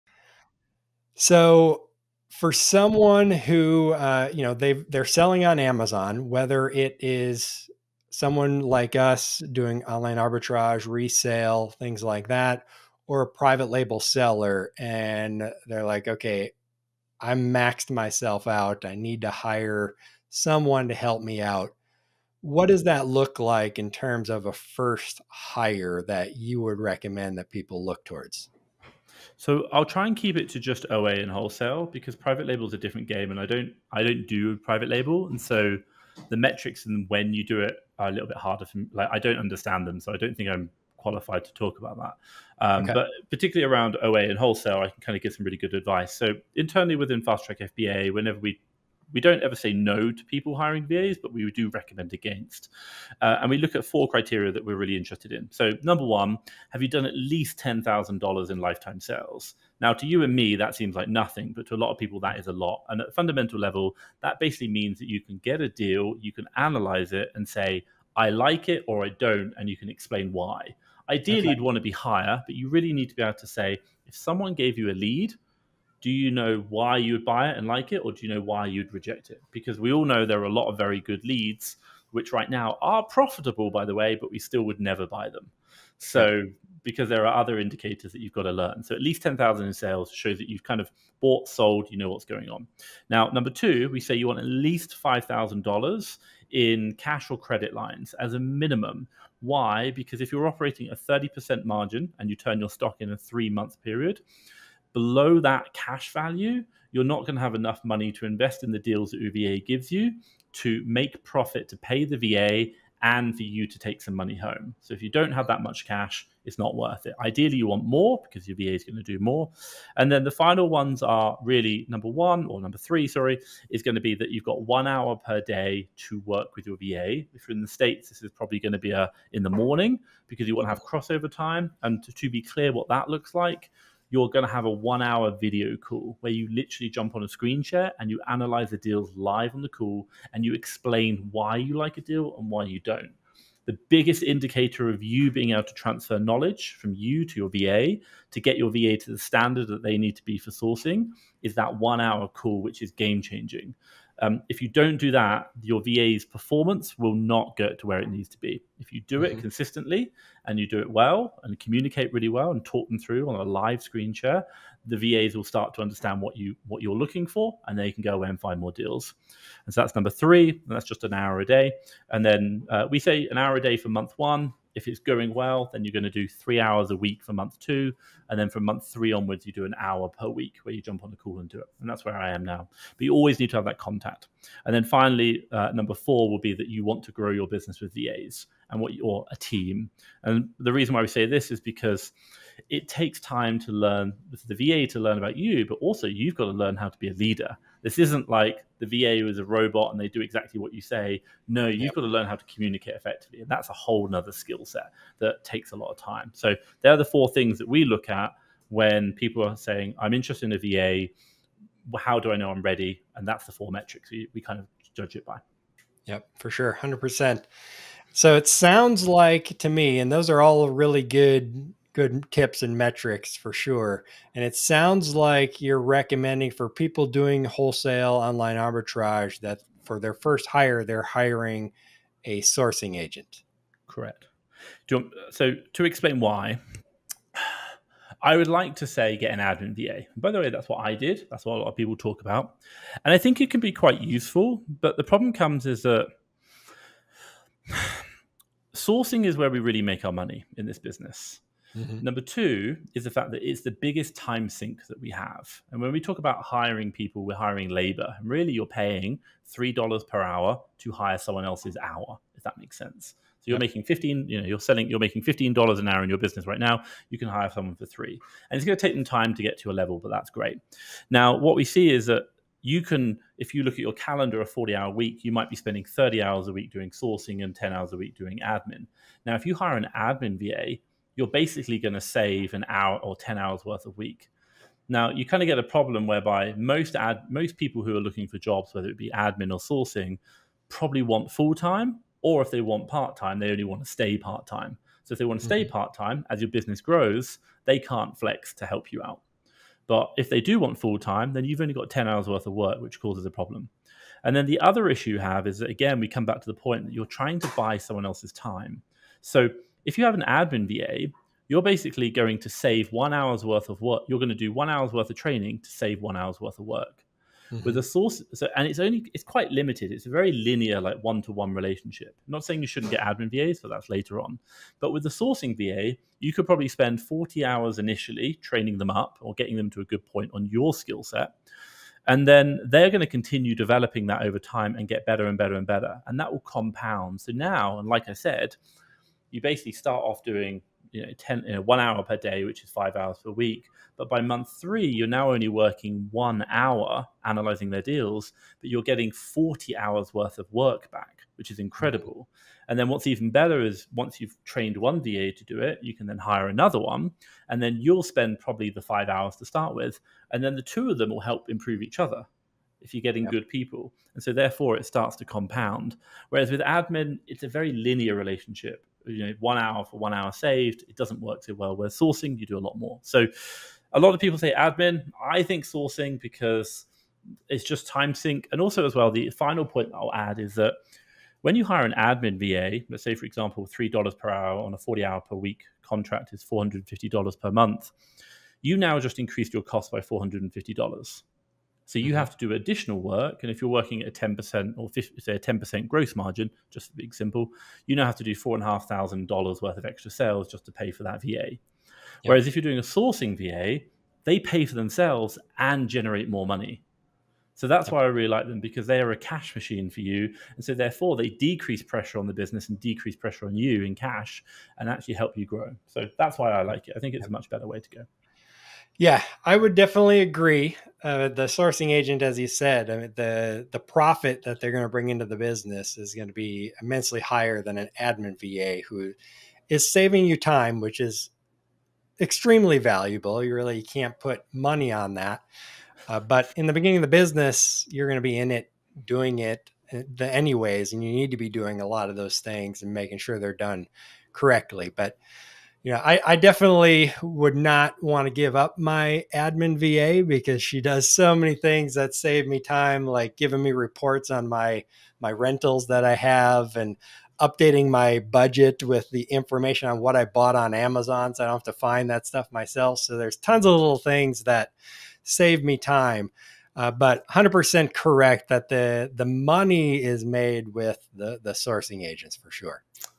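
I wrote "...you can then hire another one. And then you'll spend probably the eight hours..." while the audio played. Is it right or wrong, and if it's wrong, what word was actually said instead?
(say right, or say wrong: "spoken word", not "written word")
wrong: "five", not "eight".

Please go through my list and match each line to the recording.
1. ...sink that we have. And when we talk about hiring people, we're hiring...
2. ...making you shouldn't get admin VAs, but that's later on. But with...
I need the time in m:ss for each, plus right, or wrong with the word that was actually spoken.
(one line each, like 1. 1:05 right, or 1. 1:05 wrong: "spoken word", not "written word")
1. 4:14 right
2. 5:22 wrong: "saying", not "making".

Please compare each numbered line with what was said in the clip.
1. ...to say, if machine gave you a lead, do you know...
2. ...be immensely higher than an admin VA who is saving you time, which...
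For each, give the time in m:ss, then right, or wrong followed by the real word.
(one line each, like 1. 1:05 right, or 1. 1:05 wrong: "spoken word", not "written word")
1. 1:13 wrong: "someone", not "machine"
2. 7:06 right.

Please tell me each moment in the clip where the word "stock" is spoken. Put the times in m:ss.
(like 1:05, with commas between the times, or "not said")
1:42.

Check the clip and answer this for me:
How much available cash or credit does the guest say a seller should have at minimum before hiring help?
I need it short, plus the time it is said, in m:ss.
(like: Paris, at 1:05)
$5,000, at 1:35.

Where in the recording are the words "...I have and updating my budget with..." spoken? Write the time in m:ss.
7:36.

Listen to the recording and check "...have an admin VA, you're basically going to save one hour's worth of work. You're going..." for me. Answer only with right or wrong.
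right.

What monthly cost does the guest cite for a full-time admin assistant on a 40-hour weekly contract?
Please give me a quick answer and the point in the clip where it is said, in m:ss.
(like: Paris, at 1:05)
$450, at 6:26.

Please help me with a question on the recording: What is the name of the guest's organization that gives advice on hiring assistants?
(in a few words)
Fast Track FBA.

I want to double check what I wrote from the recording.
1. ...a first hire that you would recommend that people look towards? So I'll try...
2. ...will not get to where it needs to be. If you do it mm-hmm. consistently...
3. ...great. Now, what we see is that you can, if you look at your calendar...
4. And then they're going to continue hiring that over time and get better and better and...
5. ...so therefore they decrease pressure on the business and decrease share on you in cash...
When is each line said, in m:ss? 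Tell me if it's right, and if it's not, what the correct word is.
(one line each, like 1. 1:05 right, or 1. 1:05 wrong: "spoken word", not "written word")
1. 0:24 right
2. 2:36 right
3. 4:30 right
4. 5:32 wrong: "developing", not "hiring"
5. 6:50 wrong: "pressure", not "share".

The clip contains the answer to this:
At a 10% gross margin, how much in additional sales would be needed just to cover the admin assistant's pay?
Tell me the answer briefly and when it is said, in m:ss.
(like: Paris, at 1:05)
$4,500, at 6:38.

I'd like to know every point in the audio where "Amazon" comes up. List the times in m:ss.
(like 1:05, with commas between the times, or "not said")
0:05, 7:40.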